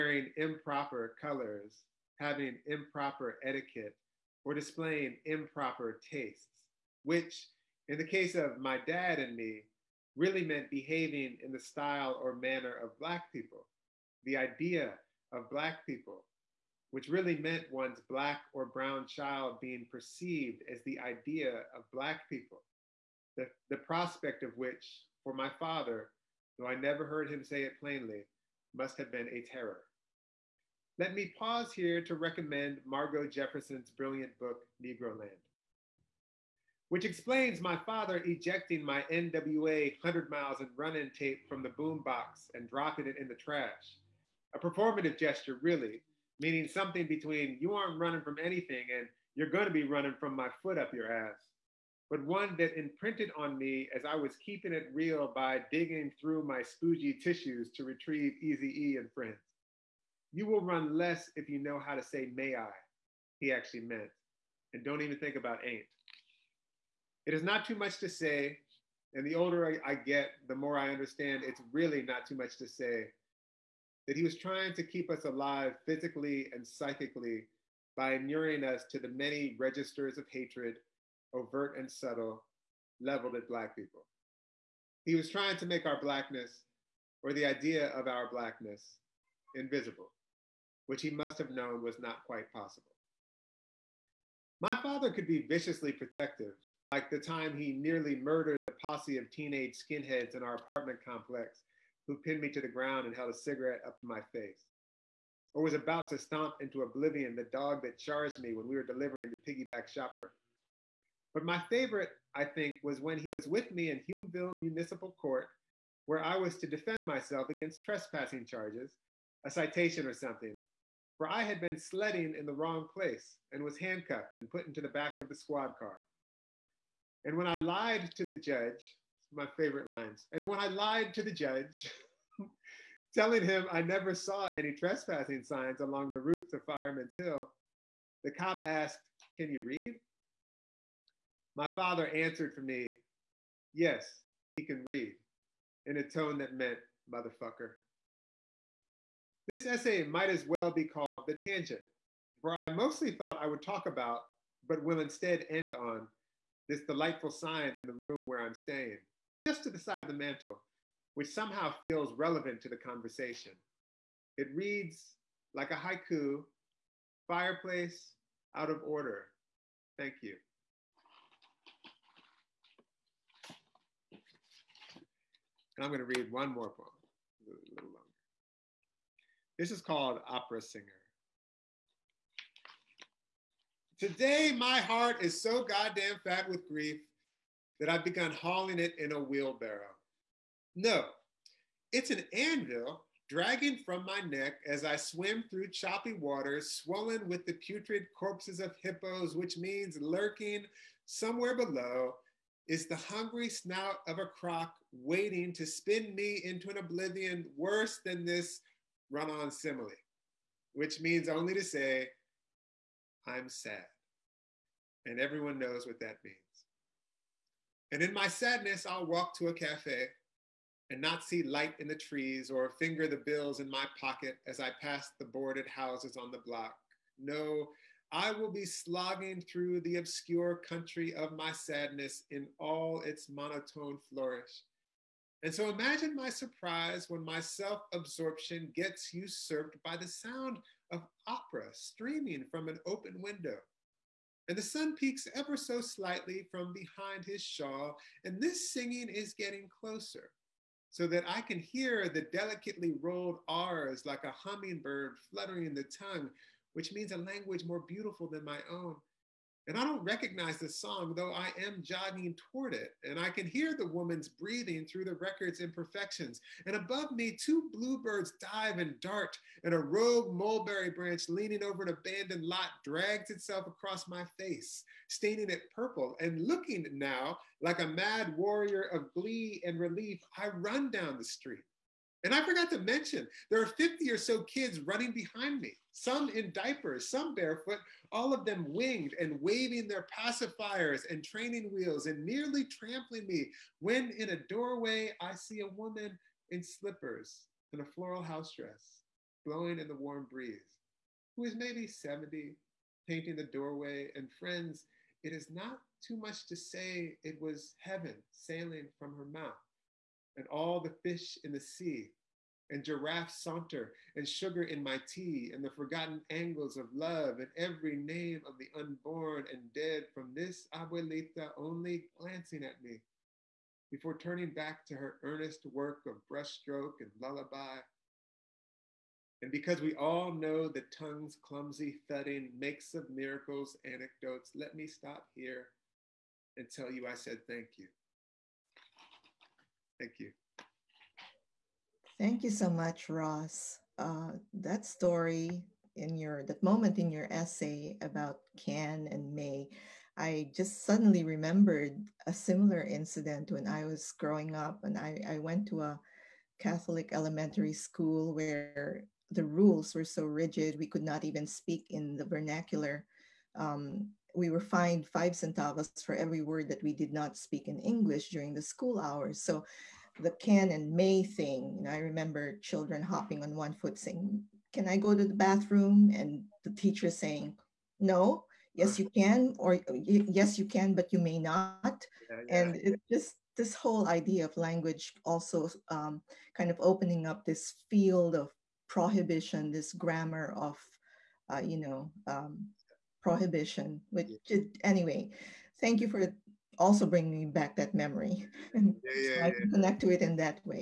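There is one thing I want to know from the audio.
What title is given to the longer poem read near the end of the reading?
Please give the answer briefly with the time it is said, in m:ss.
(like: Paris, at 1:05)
Opera Singer, at 3:00.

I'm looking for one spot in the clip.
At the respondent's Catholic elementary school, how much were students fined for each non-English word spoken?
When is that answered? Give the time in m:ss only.
6:05.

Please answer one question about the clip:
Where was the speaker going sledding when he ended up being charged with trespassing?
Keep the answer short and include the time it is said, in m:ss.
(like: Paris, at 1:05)
Fireman's Hill, at 2:16.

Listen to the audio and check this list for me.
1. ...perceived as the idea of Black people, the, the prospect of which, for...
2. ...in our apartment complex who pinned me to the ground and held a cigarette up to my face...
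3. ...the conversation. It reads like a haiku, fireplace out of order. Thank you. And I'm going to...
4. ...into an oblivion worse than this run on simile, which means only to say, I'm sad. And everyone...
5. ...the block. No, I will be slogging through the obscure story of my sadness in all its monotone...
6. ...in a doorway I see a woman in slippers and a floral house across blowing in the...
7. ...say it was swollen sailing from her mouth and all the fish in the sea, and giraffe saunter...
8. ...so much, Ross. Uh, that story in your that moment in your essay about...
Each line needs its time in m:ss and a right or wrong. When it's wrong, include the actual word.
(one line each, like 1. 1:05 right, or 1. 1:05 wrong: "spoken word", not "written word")
1. 0:19 right
2. 1:40 right
3. 2:42 right
4. 3:26 right
5. 3:46 wrong: "country", not "story"
6. 4:54 wrong: "dress", not "across"
7. 5:06 wrong: "heaven", not "swollen"
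8. 5:42 right.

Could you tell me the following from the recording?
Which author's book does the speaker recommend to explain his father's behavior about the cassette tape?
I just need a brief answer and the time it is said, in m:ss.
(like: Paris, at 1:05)
Margo Jefferson, at 0:32.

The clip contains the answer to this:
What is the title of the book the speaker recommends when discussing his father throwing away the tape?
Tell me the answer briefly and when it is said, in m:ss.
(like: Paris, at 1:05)
Negroland, at 0:34.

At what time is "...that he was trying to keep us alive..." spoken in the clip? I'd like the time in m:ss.
1:14.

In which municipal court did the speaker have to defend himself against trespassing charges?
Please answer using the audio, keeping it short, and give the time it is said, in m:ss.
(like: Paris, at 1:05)
Hulmeville Municipal Court, at 1:54.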